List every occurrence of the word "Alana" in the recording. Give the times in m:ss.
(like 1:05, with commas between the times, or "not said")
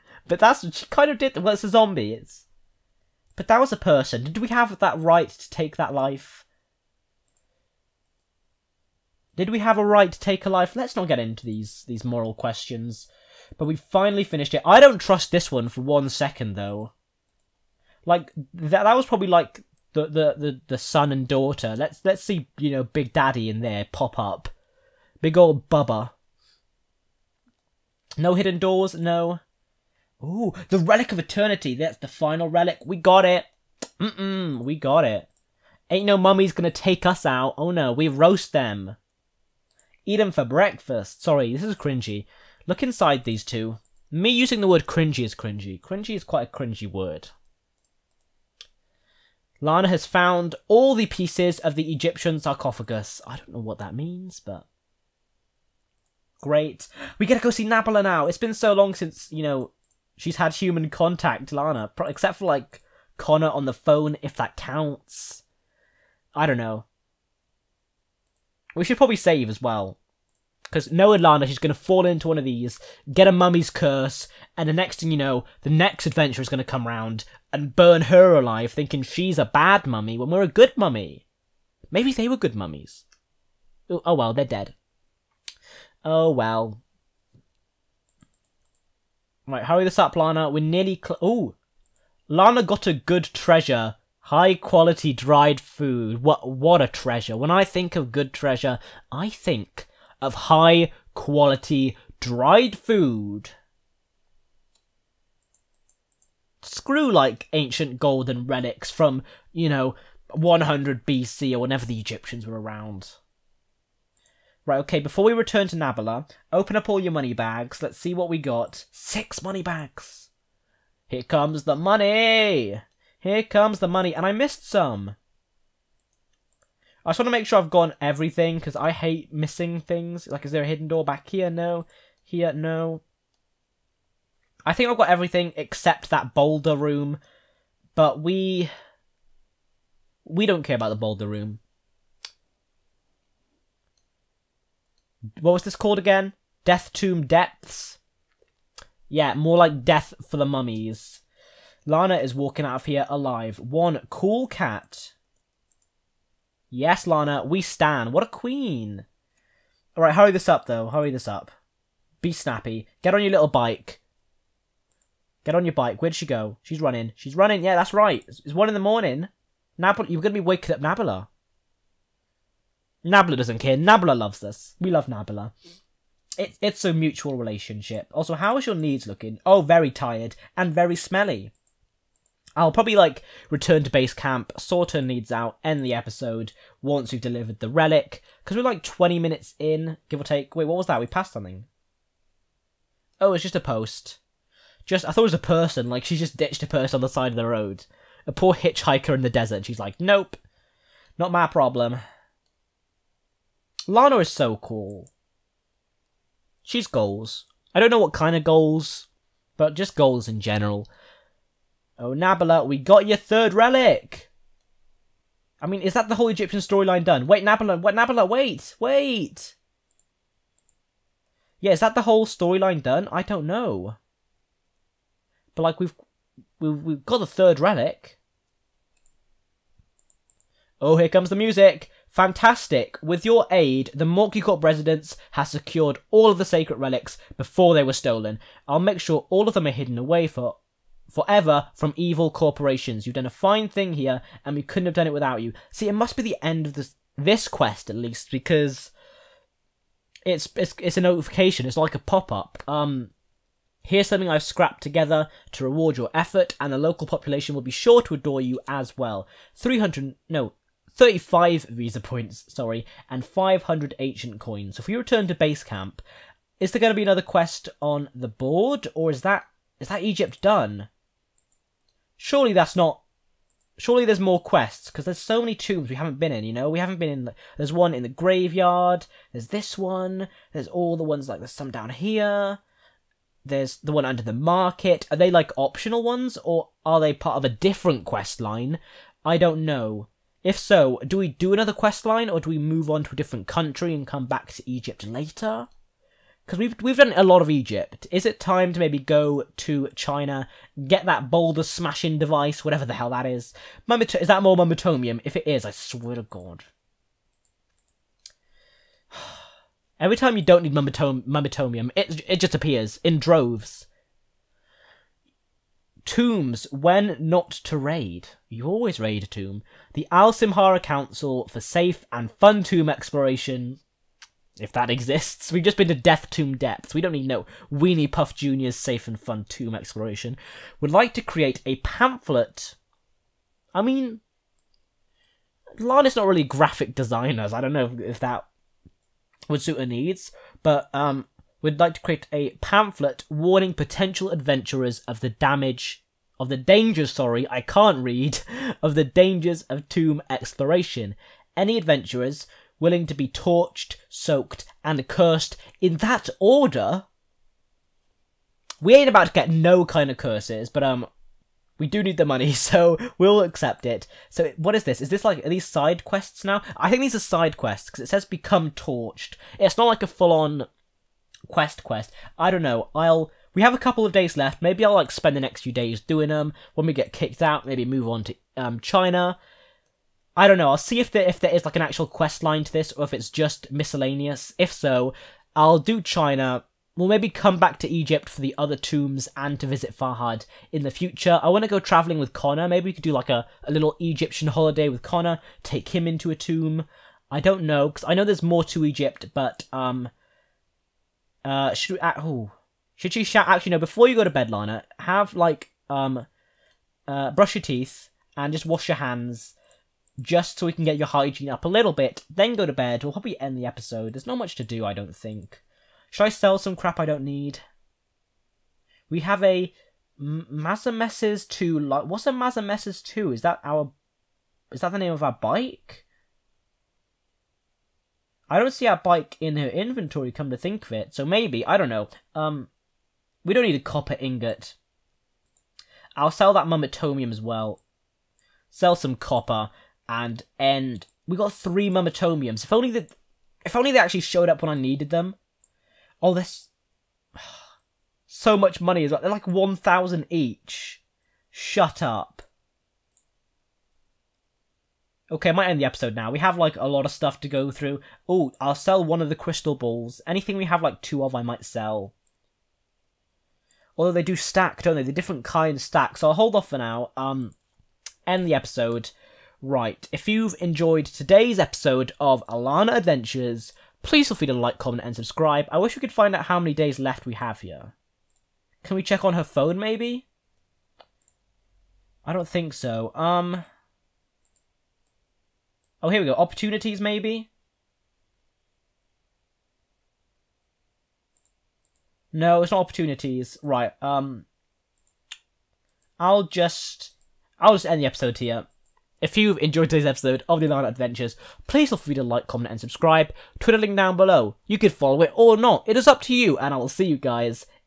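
7:52.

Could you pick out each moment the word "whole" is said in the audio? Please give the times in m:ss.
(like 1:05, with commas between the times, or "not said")
3:36, 3:42.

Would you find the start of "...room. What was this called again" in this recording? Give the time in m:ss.
2:21.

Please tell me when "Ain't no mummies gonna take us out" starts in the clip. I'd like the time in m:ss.
0:35.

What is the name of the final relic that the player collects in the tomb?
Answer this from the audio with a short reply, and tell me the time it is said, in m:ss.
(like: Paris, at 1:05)
Relic of Eternity, at 0:30.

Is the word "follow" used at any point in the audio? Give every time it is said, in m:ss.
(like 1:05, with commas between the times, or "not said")
8:24.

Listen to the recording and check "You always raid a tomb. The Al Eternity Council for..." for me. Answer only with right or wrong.
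wrong.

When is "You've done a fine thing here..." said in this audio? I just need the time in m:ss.
4:03.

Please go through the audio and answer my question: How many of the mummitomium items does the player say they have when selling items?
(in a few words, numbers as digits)
3.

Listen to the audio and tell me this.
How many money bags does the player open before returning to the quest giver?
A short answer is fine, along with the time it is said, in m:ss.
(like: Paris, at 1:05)
6, at 1:58.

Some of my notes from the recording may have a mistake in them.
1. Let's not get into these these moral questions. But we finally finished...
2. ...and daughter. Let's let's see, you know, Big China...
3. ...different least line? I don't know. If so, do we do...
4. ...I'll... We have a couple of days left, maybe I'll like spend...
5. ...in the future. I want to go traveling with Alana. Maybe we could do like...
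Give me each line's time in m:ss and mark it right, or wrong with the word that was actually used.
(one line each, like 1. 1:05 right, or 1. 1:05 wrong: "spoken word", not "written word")
1. 0:10 right
2. 0:21 wrong: "Daddy", not "China"
3. 4:47 wrong: "quest", not "least"
4. 6:12 right
5. 6:30 wrong: "Connor", not "Alana".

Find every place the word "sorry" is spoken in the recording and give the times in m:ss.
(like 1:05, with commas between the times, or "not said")
0:41, 4:22, 5:47.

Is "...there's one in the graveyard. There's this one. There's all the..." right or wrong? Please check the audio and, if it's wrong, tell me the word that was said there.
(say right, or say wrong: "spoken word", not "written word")
right.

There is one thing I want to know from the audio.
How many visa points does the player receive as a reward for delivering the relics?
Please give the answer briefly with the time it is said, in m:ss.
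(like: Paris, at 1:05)
35, at 4:20.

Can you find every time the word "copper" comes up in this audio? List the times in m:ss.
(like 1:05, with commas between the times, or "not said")
7:13, 7:19.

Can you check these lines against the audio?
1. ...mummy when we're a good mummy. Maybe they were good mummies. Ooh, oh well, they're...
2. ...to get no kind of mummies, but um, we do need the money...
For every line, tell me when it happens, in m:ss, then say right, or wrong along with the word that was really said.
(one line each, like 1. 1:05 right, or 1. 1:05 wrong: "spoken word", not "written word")
1. 1:19 right
2. 5:59 wrong: "curses", not "mummies".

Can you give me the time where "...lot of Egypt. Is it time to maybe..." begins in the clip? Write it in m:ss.
4:57.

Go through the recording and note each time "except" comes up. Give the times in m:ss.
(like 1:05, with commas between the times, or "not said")
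1:02, 2:15.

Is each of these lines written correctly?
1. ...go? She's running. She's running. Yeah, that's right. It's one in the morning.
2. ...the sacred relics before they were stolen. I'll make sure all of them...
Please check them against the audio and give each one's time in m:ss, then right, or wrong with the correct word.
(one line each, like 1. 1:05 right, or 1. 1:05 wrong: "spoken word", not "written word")
1. 2:46 right
2. 3:56 right.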